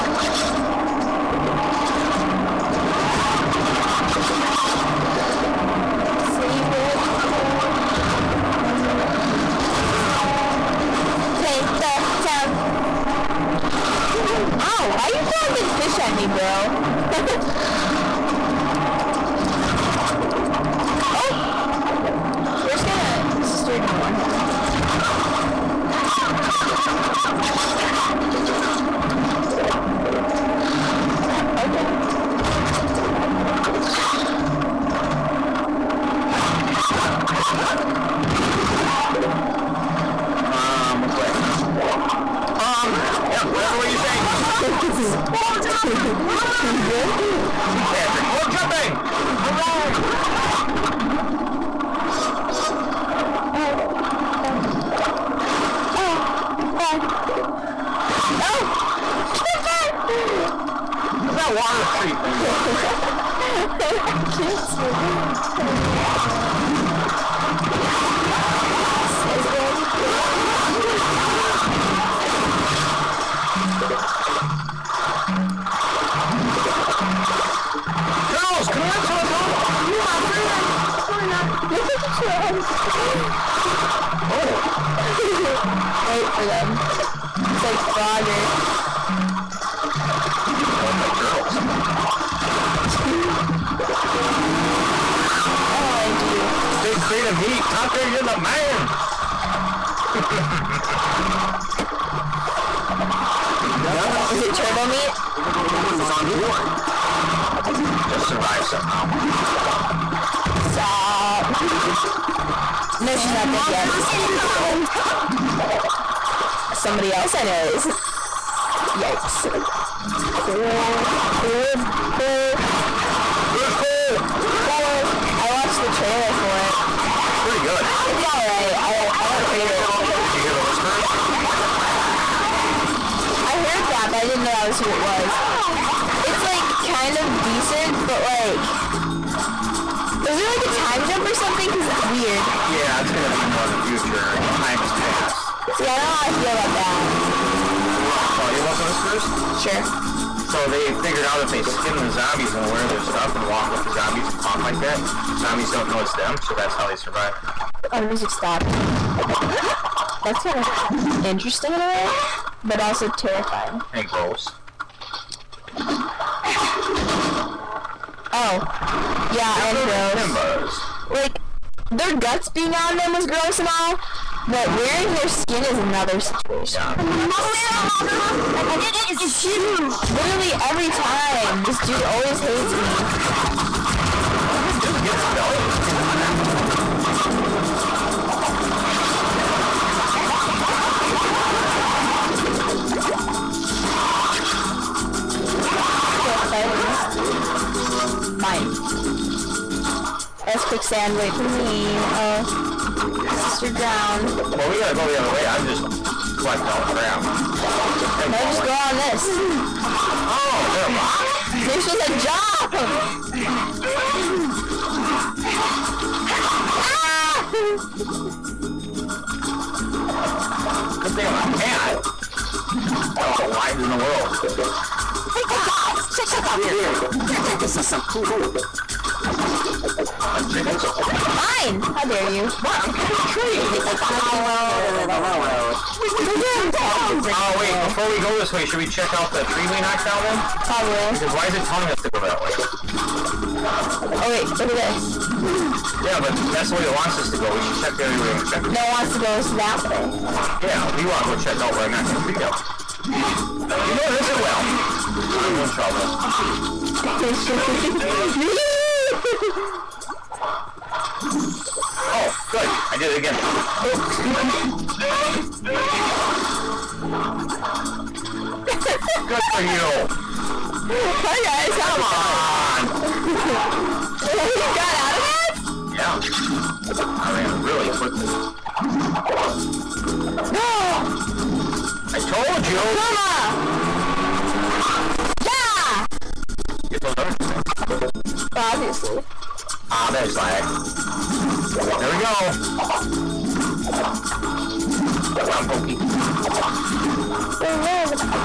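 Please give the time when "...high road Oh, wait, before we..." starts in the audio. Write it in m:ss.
3:54.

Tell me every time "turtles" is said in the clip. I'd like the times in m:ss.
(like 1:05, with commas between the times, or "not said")
1:18, 1:31, 1:44.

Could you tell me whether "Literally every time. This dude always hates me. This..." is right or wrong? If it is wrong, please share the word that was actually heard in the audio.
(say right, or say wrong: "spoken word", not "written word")
right.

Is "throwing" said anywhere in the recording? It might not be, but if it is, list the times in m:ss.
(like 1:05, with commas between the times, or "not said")
0:15.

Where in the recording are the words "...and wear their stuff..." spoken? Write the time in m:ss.
2:32.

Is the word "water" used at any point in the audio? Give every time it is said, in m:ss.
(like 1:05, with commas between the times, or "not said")
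1:01.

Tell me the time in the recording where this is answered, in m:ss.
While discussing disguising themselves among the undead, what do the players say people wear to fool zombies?
2:54.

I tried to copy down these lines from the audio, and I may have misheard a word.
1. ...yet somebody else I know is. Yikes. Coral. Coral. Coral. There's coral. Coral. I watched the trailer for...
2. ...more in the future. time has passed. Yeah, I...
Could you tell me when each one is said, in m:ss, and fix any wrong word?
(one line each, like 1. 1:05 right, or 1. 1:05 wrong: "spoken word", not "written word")
1. 1:53 right
2. 2:23 right.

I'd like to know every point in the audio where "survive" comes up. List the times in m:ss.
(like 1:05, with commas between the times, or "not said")
1:48, 2:36.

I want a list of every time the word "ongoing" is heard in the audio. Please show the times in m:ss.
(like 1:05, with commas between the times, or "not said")
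not said.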